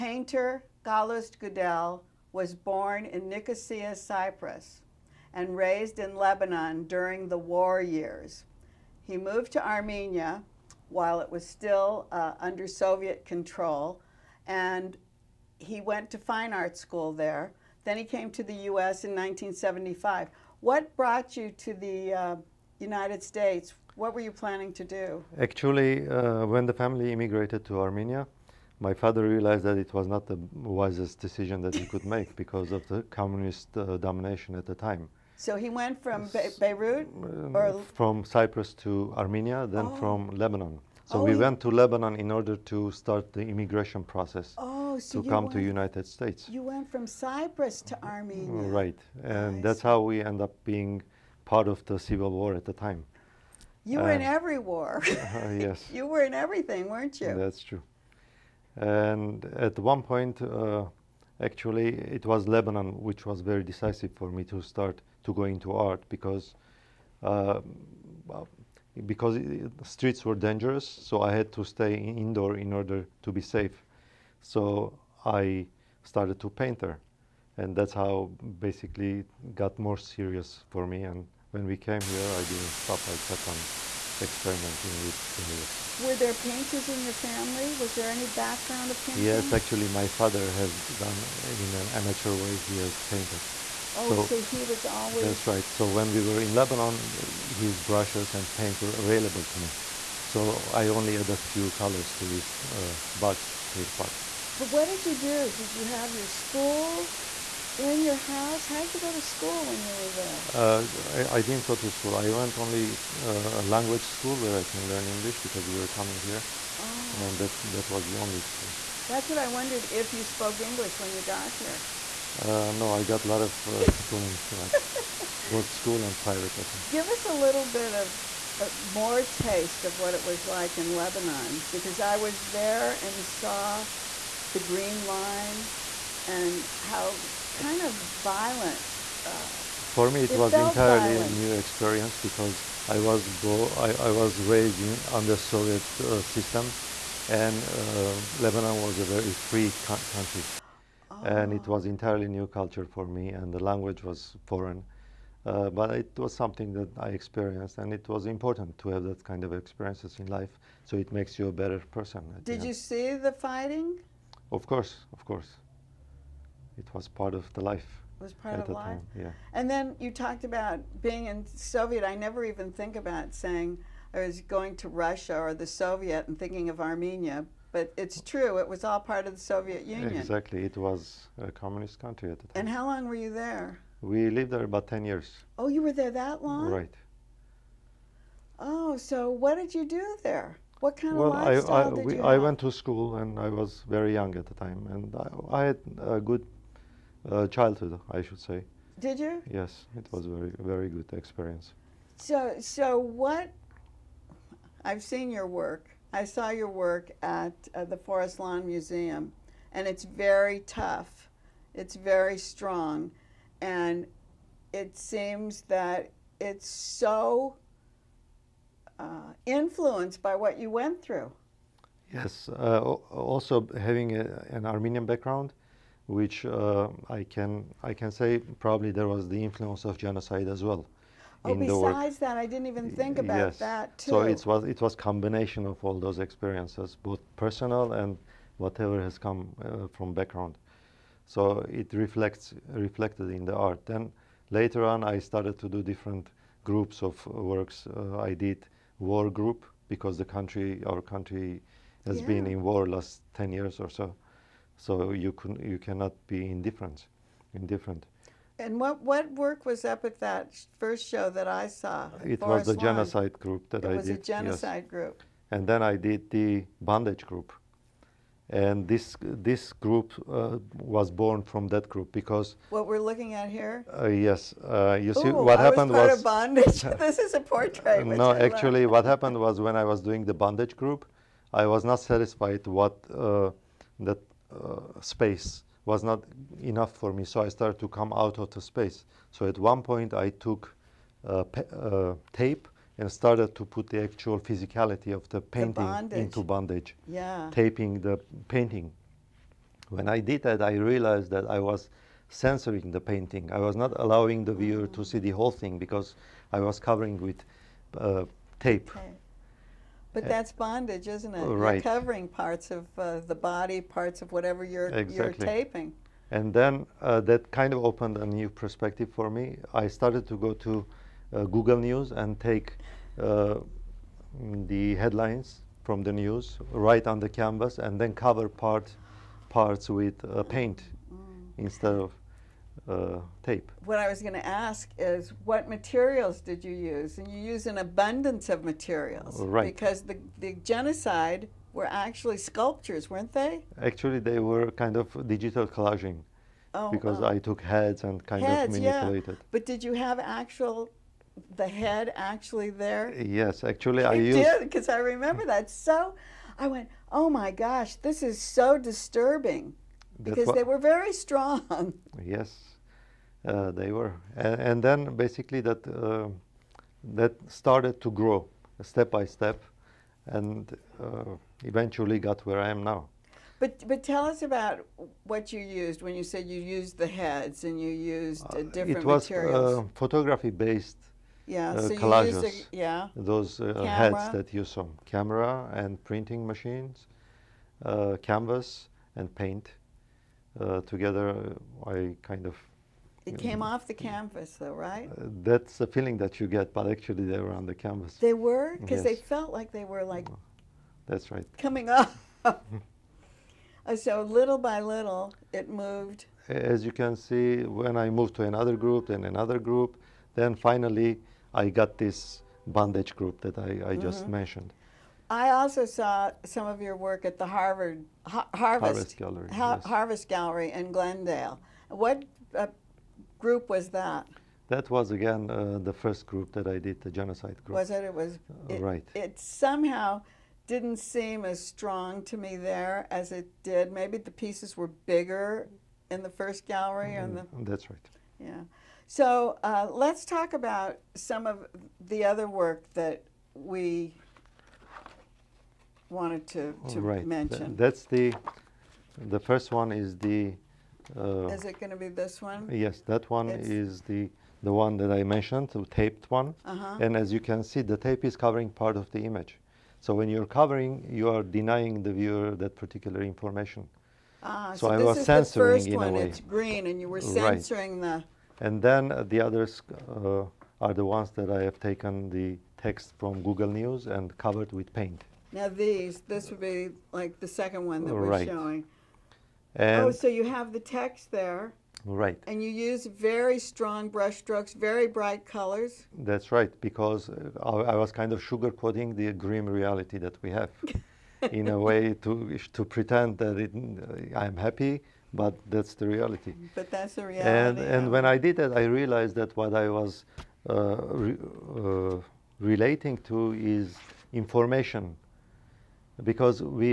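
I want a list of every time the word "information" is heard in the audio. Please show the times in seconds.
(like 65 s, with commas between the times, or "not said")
463 s, 504 s.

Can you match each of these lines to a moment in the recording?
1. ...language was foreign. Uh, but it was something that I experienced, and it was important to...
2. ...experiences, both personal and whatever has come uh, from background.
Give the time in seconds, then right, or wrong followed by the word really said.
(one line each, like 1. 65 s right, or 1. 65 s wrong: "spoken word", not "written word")
1. 153 s right
2. 236 s right.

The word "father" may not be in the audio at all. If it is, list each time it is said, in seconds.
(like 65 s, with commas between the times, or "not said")
28 s, 90 s.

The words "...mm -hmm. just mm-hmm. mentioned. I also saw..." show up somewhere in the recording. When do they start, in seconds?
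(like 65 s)
413 s.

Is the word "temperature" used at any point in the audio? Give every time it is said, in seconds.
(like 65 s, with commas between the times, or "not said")
not said.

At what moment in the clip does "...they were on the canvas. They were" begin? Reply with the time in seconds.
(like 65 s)
397 s.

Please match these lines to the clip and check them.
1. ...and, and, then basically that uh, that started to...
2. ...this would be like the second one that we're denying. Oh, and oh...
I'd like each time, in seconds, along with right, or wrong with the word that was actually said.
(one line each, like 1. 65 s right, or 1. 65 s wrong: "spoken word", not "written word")
1. 364 s right
2. 476 s wrong: "showing", not "denying".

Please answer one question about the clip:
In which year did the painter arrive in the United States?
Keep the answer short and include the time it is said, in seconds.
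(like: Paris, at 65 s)
1975, at 19 s.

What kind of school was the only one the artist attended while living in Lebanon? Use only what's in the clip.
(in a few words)
A language school.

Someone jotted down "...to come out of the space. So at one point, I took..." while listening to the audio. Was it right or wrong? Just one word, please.
right.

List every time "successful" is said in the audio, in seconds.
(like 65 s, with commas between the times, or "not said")
not said.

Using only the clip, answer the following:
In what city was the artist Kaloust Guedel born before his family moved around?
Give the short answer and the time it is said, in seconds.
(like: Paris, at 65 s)
Nicosia, at 3 s.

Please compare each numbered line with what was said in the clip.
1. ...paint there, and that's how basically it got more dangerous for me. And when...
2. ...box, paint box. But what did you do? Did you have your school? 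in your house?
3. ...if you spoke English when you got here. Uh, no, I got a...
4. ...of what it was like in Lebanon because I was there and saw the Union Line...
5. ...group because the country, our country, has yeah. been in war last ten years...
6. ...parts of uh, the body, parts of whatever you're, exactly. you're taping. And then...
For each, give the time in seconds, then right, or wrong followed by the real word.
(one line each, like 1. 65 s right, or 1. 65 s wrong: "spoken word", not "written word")
1. 76 s wrong: "serious", not "dangerous"
2. 103 s right
3. 119 s right
4. 129 s wrong: "Green", not "Union"
5. 249 s right
6. 312 s right.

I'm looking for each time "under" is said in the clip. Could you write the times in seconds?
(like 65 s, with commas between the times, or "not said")
12 s, 145 s.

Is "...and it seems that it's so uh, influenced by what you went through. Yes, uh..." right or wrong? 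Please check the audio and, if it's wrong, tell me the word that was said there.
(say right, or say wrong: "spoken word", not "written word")
right.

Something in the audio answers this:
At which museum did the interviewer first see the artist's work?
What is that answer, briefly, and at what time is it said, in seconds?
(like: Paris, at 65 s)
Forest Lawn Museum, at 207 s.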